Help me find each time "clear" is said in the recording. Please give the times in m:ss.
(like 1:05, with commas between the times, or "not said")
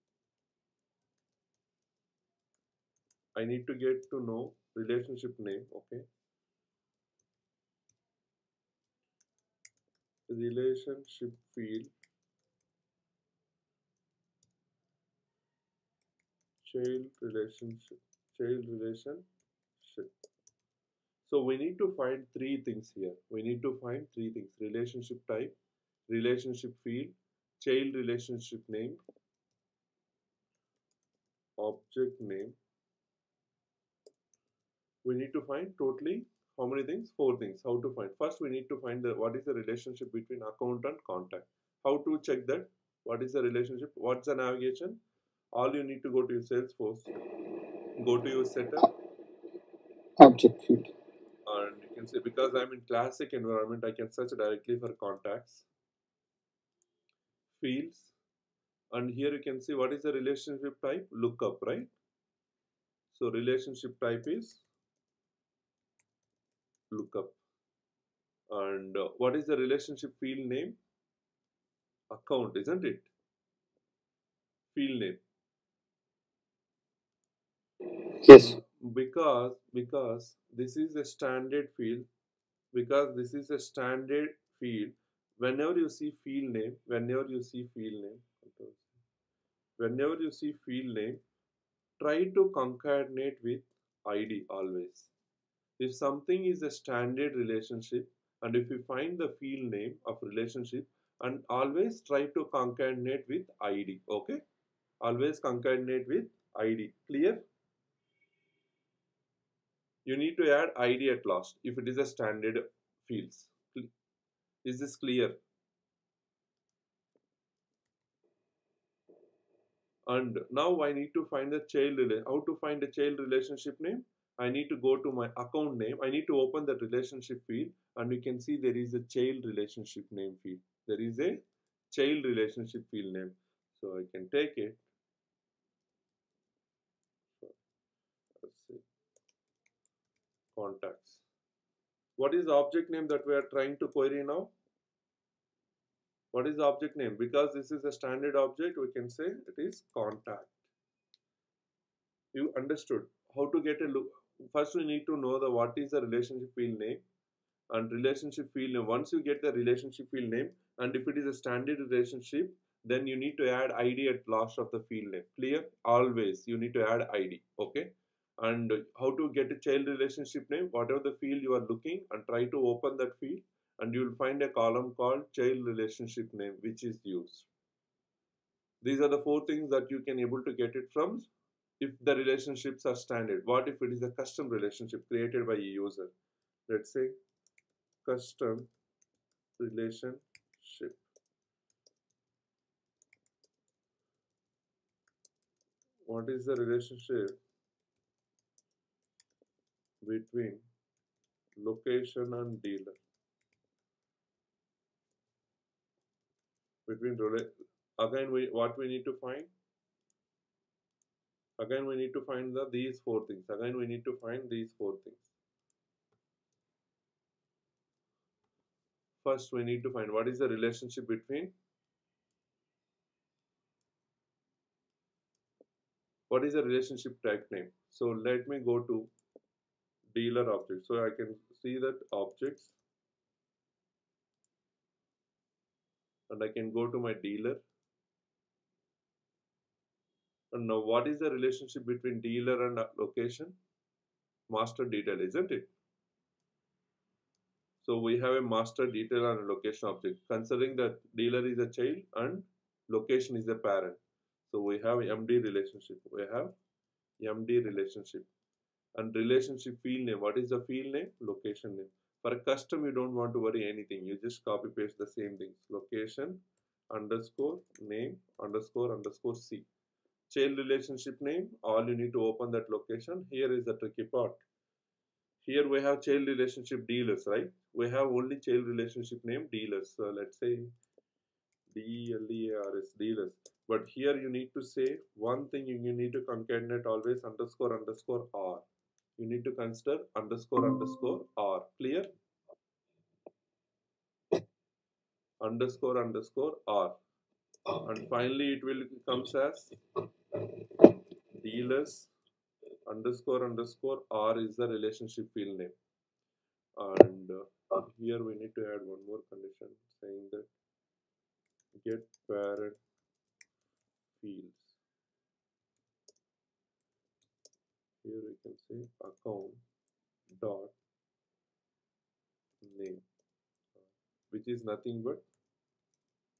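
1:47, 1:54, 2:45, 4:51.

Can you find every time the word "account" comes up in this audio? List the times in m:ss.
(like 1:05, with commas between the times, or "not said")
0:40, 1:12, 2:05, 5:19.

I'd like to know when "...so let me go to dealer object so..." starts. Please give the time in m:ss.
3:47.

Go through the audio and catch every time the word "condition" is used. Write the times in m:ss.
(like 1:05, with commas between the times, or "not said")
5:09.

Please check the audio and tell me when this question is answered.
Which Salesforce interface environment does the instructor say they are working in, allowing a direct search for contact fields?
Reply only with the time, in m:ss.
0:52.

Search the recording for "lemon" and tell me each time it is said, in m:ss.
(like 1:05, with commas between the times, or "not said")
not said.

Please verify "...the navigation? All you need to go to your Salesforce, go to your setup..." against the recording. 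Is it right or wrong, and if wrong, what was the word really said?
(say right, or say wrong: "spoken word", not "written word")
right.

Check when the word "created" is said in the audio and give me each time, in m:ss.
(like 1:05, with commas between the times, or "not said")
3:05.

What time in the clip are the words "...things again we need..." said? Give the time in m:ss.
3:33.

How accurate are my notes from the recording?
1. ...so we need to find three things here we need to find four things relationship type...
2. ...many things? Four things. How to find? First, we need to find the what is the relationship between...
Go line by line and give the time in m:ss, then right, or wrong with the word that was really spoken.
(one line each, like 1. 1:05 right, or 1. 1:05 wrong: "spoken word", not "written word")
1. 0:21 wrong: "three", not "four"
2. 0:36 right.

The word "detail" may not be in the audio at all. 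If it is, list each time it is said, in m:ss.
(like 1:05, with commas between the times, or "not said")
4:04, 4:08.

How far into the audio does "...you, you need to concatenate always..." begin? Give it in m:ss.
4:45.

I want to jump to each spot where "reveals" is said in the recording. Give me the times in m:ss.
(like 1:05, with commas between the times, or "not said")
not said.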